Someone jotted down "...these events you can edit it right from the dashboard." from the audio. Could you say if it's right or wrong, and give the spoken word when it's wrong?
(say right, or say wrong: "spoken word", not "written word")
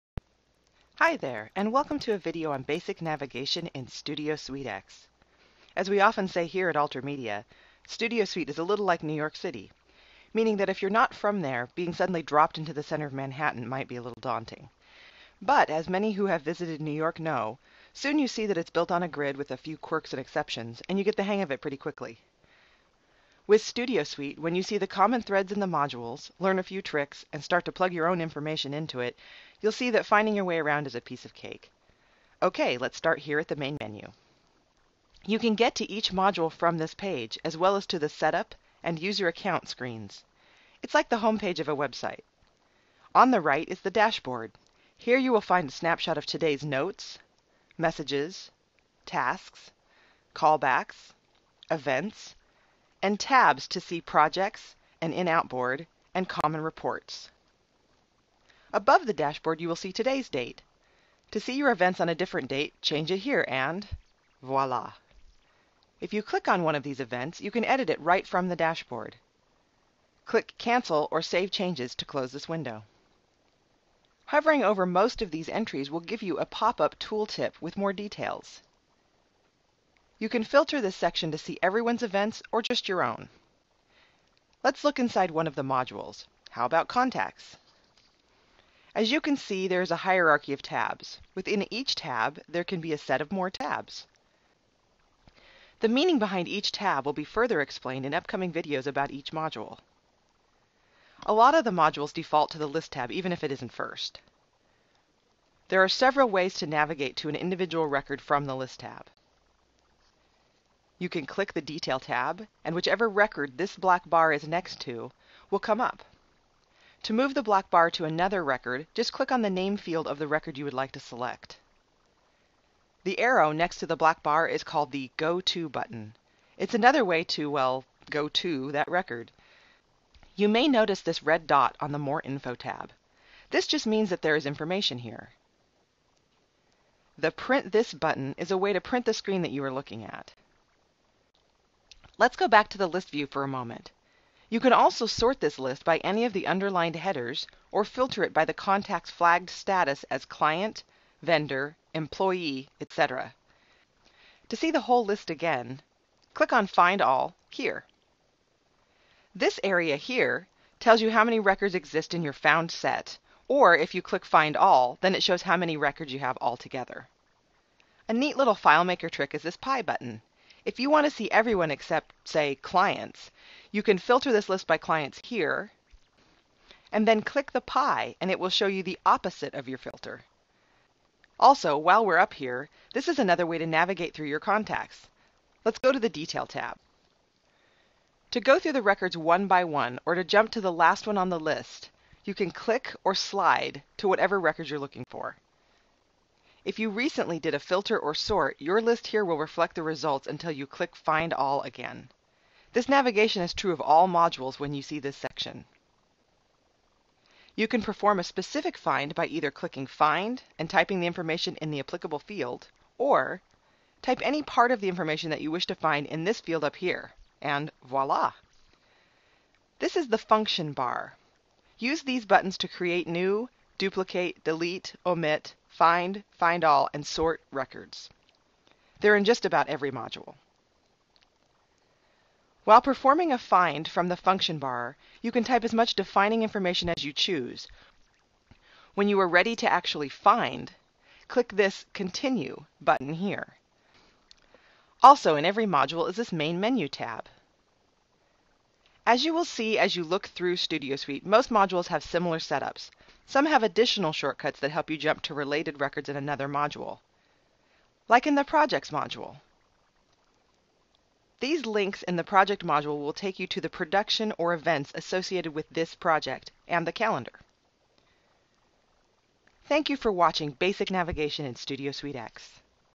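right.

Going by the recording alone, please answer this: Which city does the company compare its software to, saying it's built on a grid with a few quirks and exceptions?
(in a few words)
New York City.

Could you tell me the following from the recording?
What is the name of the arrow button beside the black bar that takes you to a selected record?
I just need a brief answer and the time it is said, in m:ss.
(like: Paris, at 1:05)
Go To button, at 2:05.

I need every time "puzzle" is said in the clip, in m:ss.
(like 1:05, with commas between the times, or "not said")
not said.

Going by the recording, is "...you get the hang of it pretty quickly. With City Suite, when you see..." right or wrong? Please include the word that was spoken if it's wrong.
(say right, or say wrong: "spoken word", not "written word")
wrong: "Studio", not "City".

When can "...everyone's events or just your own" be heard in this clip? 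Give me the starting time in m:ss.
1:21.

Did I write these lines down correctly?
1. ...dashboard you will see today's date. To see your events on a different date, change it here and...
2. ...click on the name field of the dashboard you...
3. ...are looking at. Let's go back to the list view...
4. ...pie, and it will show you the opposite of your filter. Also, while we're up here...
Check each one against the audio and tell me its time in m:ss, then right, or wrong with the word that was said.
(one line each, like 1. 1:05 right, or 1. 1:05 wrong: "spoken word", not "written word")
1. 0:59 right
2. 1:59 wrong: "record", not "dashboard"
3. 2:19 right
4. 2:57 right.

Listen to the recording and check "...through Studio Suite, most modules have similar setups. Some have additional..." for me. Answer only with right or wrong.
right.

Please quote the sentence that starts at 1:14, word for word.
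Hovering over most of these entries will give you a pop-up tooltip with more details.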